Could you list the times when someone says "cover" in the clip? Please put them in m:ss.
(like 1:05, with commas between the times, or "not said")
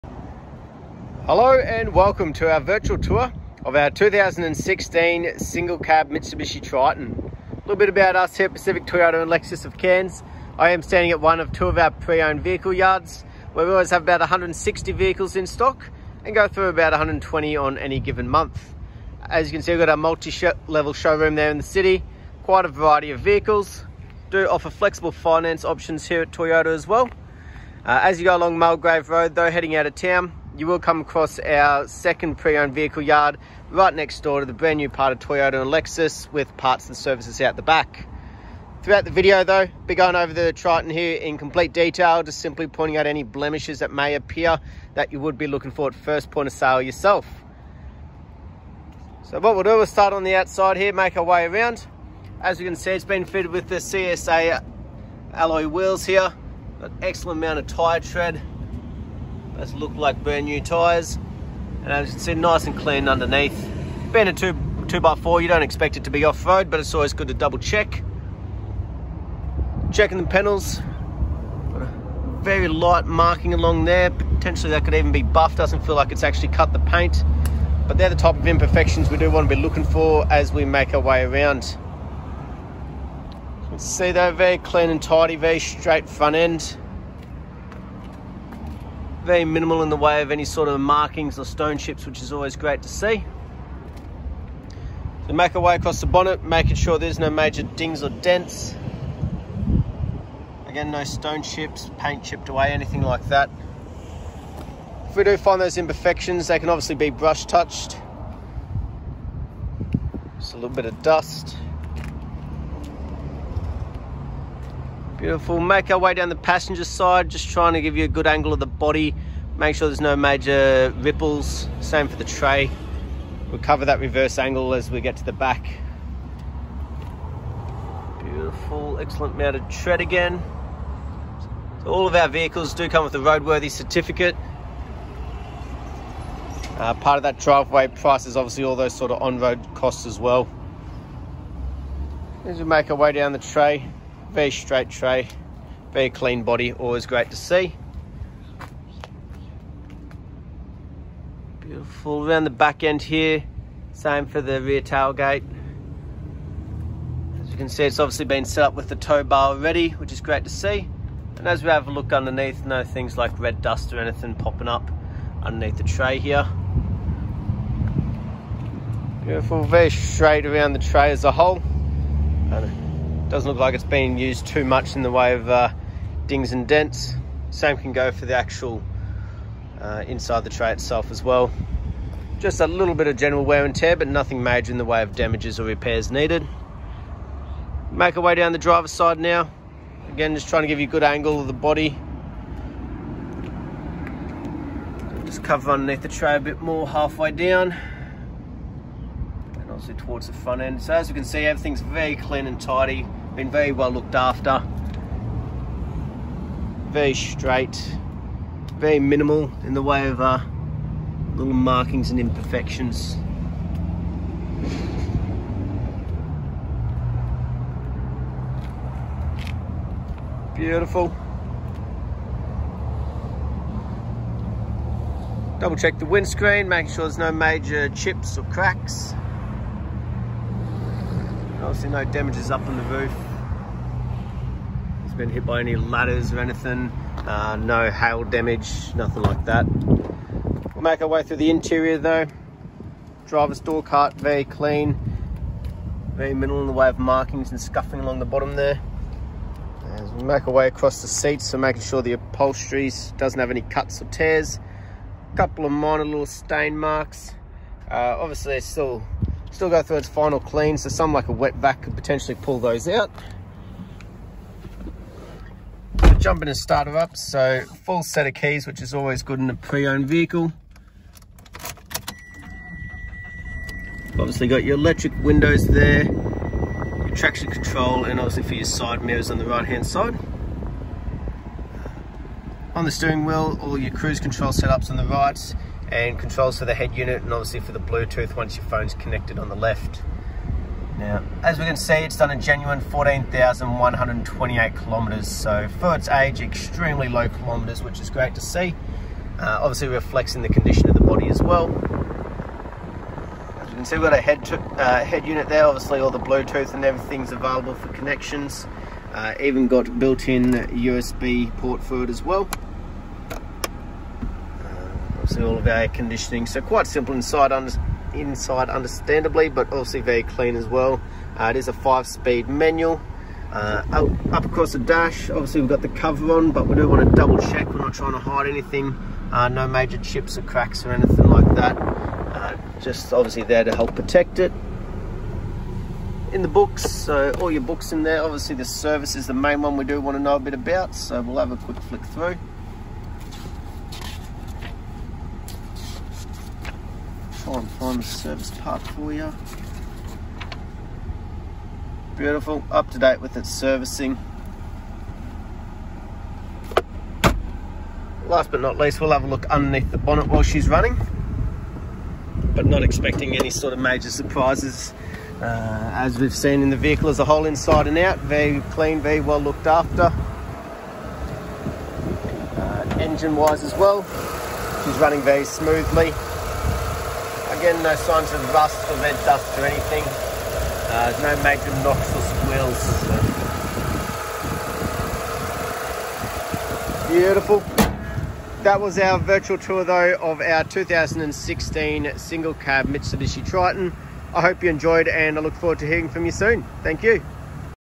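2:03, 3:15, 5:25.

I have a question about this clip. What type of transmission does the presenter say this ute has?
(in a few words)
Five-speed manual.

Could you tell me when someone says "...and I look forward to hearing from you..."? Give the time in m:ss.
6:35.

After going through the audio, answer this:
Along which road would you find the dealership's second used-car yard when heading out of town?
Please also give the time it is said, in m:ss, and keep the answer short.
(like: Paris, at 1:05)
Mulgrave Road, at 0:28.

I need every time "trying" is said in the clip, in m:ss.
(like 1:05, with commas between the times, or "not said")
1:57, 3:10, 5:27.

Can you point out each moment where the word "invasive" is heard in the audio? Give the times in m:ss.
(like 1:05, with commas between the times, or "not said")
not said.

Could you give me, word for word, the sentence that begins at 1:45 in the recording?
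If we do find those imperfections, they can obviously be brush touched.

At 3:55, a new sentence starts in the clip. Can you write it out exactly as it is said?
It's been hit by any ladders or anything.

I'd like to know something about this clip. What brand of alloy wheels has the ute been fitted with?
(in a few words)
CSA.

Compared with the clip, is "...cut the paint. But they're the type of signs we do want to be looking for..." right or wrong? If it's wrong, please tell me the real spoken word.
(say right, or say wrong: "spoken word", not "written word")
wrong: "imperfections", not "signs".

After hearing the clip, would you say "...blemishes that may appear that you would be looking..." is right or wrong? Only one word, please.
right.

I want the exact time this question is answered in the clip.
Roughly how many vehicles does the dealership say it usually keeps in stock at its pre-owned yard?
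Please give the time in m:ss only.
0:14.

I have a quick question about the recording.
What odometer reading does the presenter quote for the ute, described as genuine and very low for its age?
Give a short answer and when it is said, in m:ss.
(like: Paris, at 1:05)
14,128 kilometres, at 4:52.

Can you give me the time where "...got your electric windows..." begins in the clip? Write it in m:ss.
4:34.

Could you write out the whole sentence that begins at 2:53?
Doesn't look like it's been used too much in the way of uh, dings and dents.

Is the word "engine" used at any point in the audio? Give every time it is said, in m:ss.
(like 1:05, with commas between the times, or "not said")
6:12.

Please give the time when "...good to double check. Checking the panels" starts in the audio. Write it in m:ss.
1:07.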